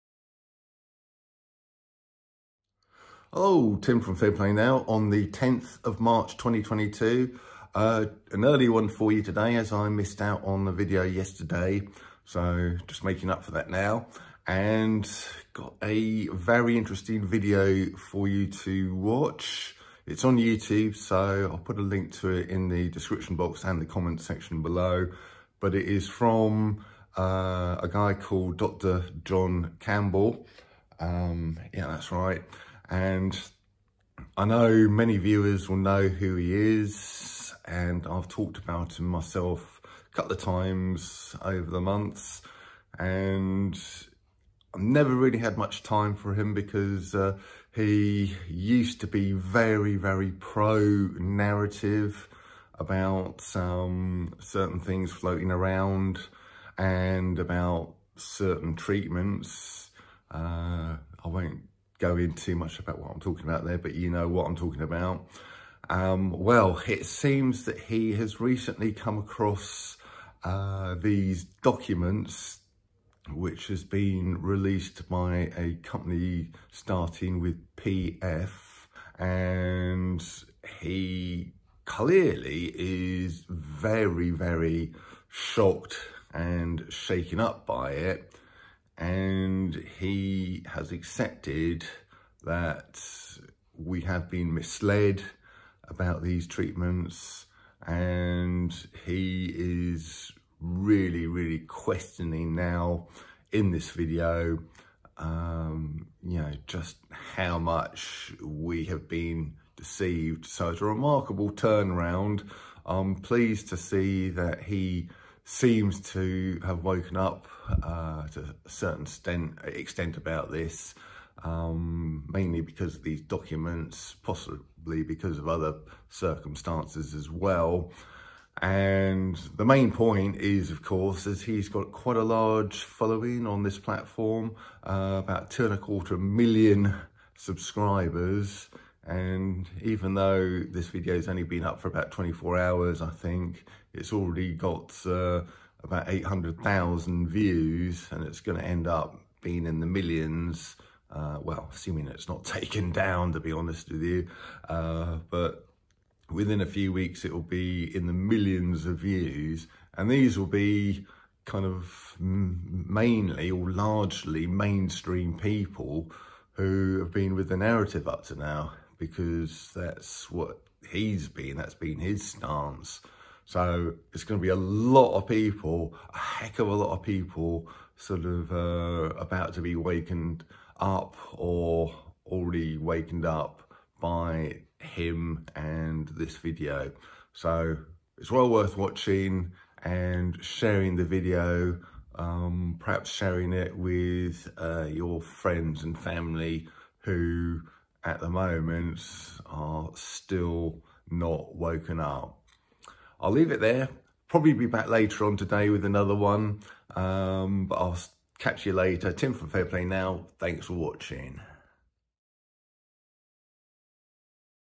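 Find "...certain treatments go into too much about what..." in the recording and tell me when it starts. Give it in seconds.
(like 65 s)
58 s.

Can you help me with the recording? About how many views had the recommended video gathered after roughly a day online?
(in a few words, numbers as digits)
800,000.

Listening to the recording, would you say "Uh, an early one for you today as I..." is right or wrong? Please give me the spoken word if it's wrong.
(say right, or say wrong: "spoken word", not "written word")
right.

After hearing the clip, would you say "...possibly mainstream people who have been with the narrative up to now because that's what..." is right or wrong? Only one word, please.
wrong.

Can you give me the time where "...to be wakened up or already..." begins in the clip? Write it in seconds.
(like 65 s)
179 s.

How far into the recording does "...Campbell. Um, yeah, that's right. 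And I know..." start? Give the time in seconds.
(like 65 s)
29 s.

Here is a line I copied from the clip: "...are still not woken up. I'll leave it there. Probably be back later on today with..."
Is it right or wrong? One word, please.
right.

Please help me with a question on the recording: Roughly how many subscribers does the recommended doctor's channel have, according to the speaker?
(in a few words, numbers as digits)
2.25 million.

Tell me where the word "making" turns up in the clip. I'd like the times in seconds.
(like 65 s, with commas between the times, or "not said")
13 s.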